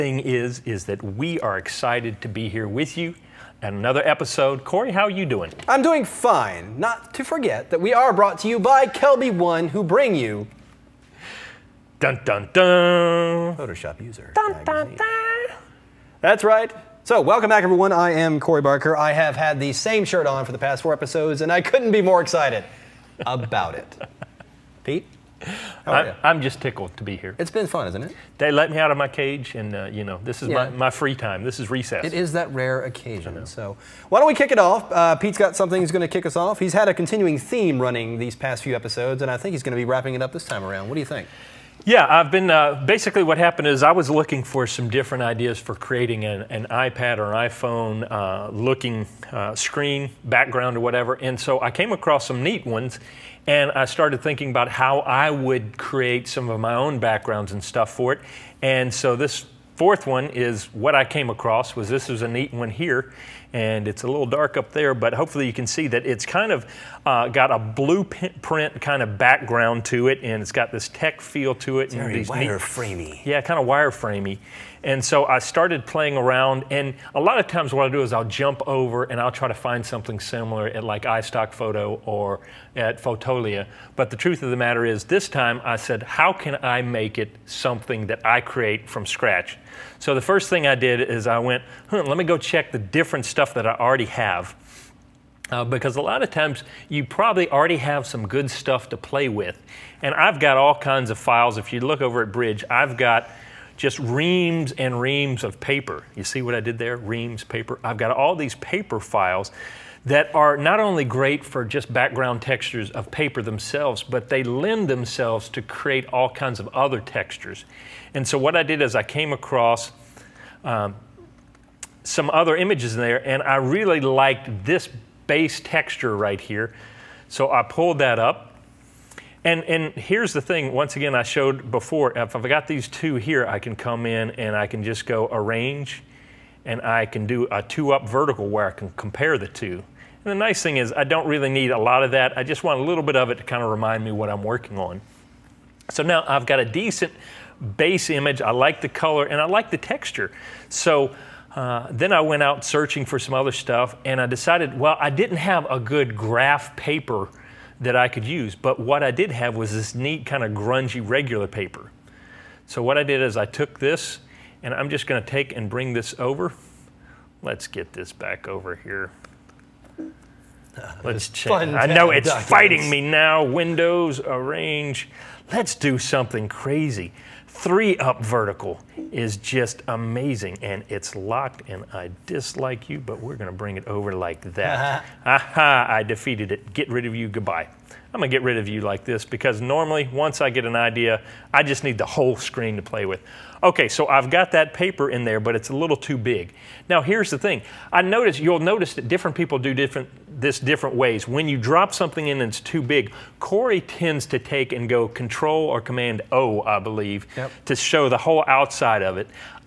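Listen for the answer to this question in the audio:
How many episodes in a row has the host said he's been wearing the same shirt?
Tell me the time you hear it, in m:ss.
0:20.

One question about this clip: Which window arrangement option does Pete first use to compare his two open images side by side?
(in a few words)
Two-up vertical.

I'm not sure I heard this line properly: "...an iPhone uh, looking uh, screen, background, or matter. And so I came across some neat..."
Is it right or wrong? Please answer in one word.
wrong.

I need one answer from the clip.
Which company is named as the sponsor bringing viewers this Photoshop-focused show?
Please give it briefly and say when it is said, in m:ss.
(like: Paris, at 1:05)
Kelby One, at 0:08.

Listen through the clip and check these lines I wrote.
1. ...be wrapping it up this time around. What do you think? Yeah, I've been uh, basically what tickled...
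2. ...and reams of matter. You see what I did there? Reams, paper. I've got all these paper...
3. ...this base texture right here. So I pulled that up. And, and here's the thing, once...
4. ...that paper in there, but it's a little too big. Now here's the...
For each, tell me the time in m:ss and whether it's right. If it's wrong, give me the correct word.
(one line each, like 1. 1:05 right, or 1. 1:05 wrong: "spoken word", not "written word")
1. 0:39 wrong: "happened", not "tickled"
2. 1:44 wrong: "paper", not "matter"
3. 2:04 right
4. 3:14 right.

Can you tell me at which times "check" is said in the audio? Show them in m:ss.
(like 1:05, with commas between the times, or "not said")
1:32, 2:51.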